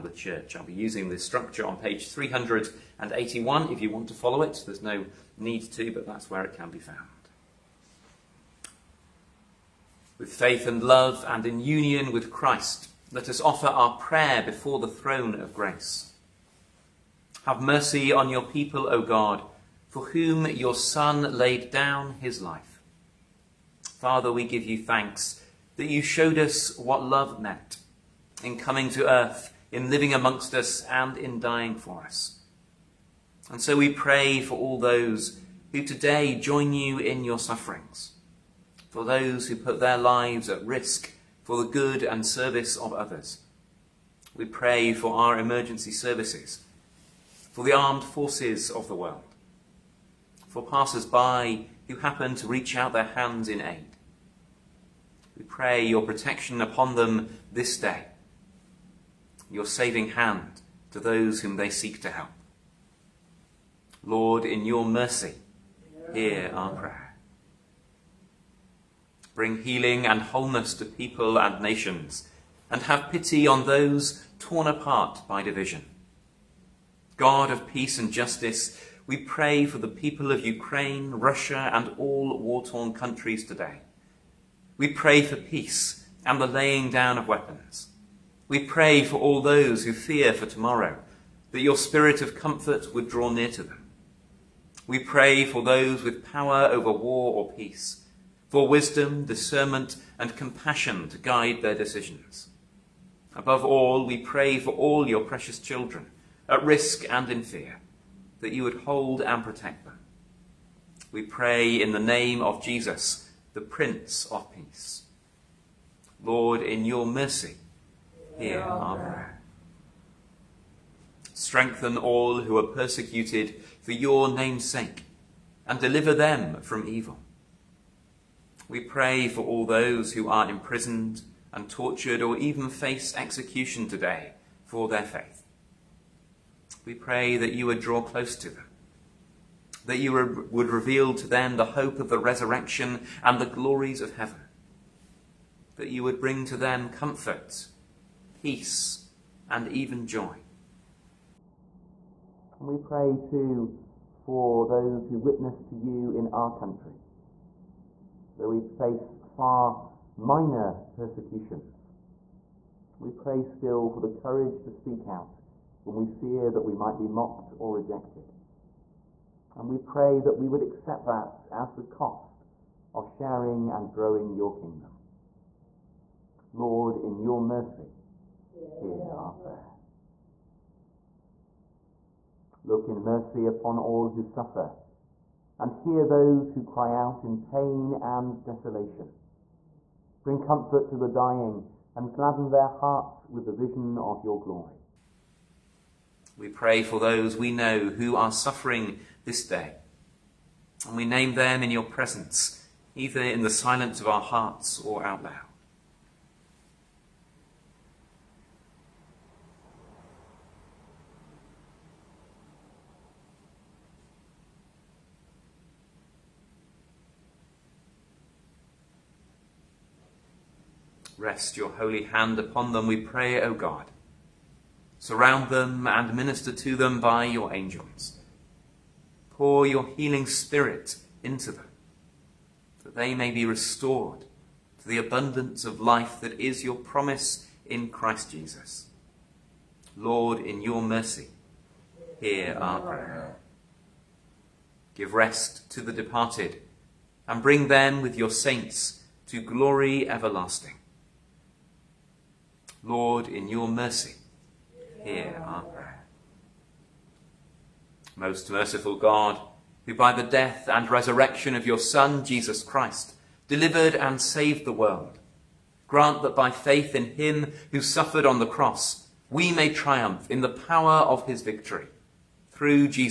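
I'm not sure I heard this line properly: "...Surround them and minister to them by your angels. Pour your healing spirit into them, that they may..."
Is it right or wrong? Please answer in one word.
right.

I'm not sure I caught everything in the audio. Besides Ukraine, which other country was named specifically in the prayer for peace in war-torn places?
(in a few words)
Russia.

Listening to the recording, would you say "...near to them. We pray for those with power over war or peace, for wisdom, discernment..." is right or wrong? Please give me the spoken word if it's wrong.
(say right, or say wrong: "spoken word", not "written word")
right.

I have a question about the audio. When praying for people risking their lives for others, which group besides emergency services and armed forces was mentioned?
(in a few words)
Passers-by.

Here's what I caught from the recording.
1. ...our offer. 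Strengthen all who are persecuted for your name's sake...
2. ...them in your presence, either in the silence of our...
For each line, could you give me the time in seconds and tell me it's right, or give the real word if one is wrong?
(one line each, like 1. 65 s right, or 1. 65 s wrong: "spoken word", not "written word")
1. 118 s wrong: "prayer", not "offer"
2. 201 s right.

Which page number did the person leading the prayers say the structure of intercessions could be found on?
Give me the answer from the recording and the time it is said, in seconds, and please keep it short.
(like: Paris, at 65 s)
381, at 1 s.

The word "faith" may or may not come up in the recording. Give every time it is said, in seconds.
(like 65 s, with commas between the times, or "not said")
10 s, 135 s, 266 s.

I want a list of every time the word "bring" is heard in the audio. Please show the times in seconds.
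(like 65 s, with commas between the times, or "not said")
69 s, 146 s, 190 s, 247 s.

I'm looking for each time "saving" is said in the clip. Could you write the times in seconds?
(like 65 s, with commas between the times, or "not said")
59 s.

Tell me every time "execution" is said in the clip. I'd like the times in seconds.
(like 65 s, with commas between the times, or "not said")
133 s.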